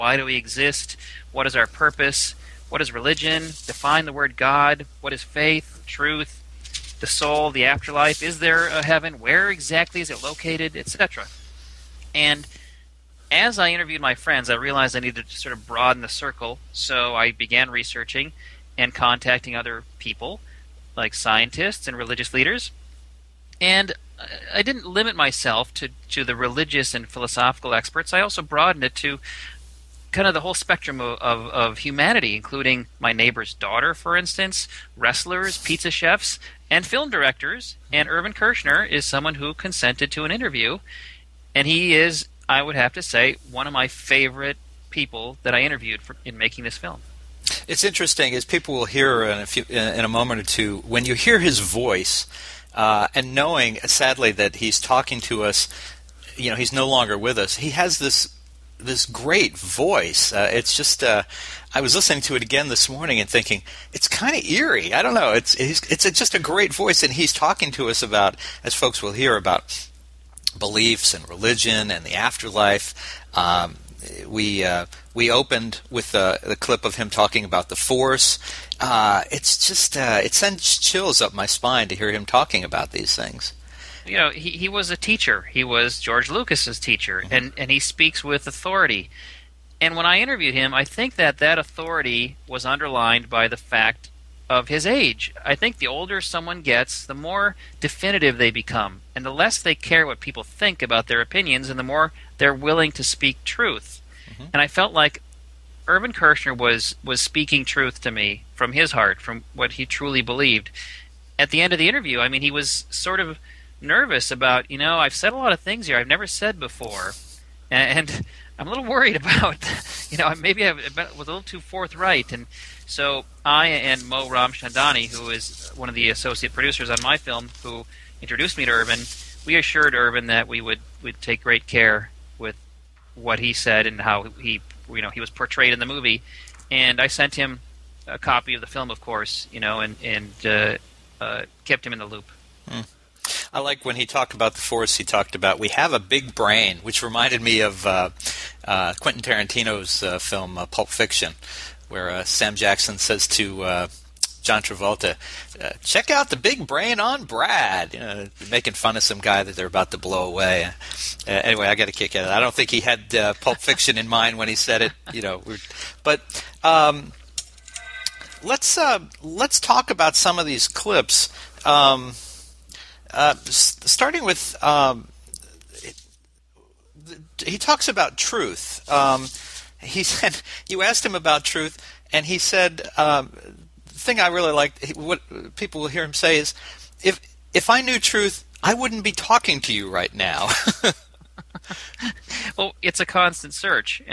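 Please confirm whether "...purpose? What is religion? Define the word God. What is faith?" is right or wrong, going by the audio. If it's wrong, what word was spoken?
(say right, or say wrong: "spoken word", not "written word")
right.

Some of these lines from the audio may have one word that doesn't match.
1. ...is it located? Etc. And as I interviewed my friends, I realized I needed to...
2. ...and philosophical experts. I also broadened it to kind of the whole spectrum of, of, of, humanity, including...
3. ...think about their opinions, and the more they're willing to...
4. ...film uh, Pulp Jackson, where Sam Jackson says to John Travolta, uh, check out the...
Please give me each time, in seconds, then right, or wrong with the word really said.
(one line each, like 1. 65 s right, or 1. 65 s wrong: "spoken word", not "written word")
1. 10 s right
2. 26 s right
3. 100 s right
4. 150 s wrong: "Fiction", not "Jackson".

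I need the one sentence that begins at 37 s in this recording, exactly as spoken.
And Irvin Kershner is someone who consented to an interview.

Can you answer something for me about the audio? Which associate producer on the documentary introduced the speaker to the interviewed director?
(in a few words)
Mo Ramchandani.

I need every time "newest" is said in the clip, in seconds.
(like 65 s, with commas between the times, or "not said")
not said.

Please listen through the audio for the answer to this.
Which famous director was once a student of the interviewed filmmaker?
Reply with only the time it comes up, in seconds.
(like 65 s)
85 s.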